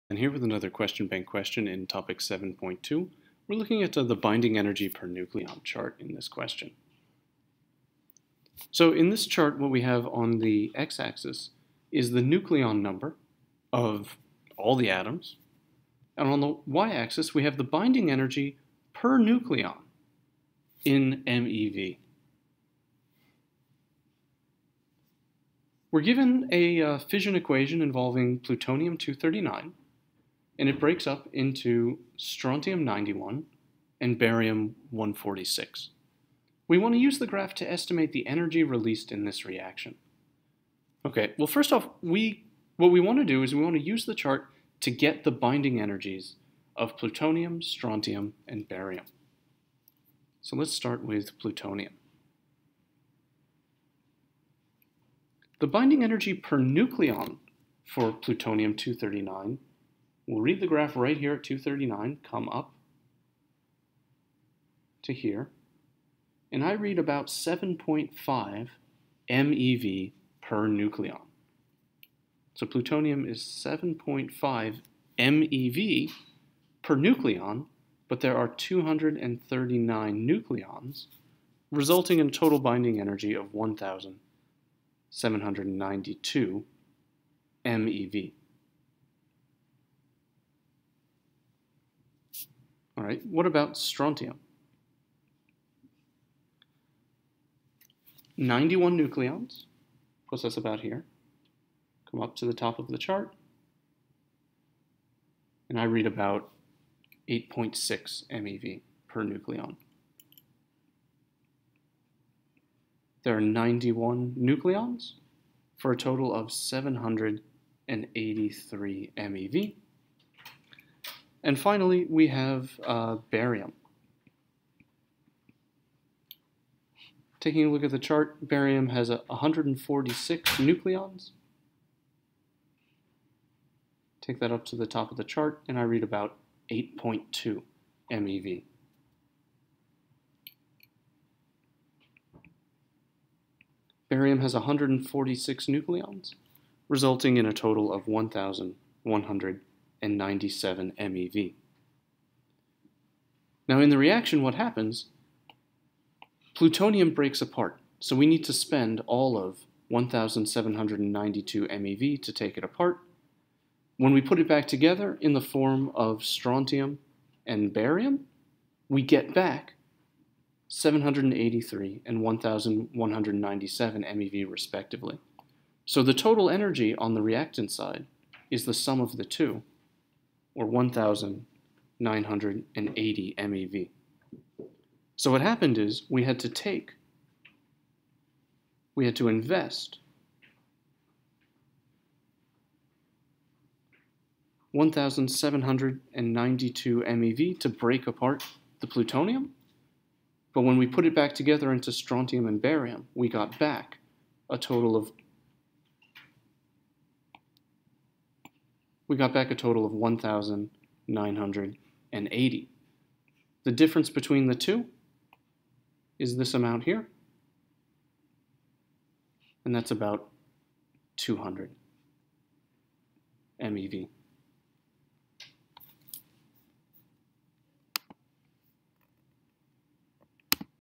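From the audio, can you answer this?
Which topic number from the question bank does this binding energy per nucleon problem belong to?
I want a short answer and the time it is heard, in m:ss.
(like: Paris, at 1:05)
7.2, at 0:02.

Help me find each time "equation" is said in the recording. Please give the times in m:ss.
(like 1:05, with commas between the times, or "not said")
0:27.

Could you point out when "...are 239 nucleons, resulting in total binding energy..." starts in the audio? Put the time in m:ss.
1:18.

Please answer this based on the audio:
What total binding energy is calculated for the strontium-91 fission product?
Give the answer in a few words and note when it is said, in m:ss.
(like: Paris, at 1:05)
783 MeV, at 1:56.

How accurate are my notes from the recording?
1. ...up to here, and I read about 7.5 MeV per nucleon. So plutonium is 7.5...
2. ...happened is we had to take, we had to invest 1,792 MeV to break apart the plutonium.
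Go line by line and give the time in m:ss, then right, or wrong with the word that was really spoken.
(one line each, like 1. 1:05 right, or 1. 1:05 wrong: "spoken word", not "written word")
1. 1:02 right
2. 3:05 right.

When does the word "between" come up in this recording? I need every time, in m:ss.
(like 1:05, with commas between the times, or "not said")
3:34.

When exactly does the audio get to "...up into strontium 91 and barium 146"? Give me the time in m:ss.
0:31.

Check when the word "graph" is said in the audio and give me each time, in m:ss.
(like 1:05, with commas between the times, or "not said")
0:37, 1:00.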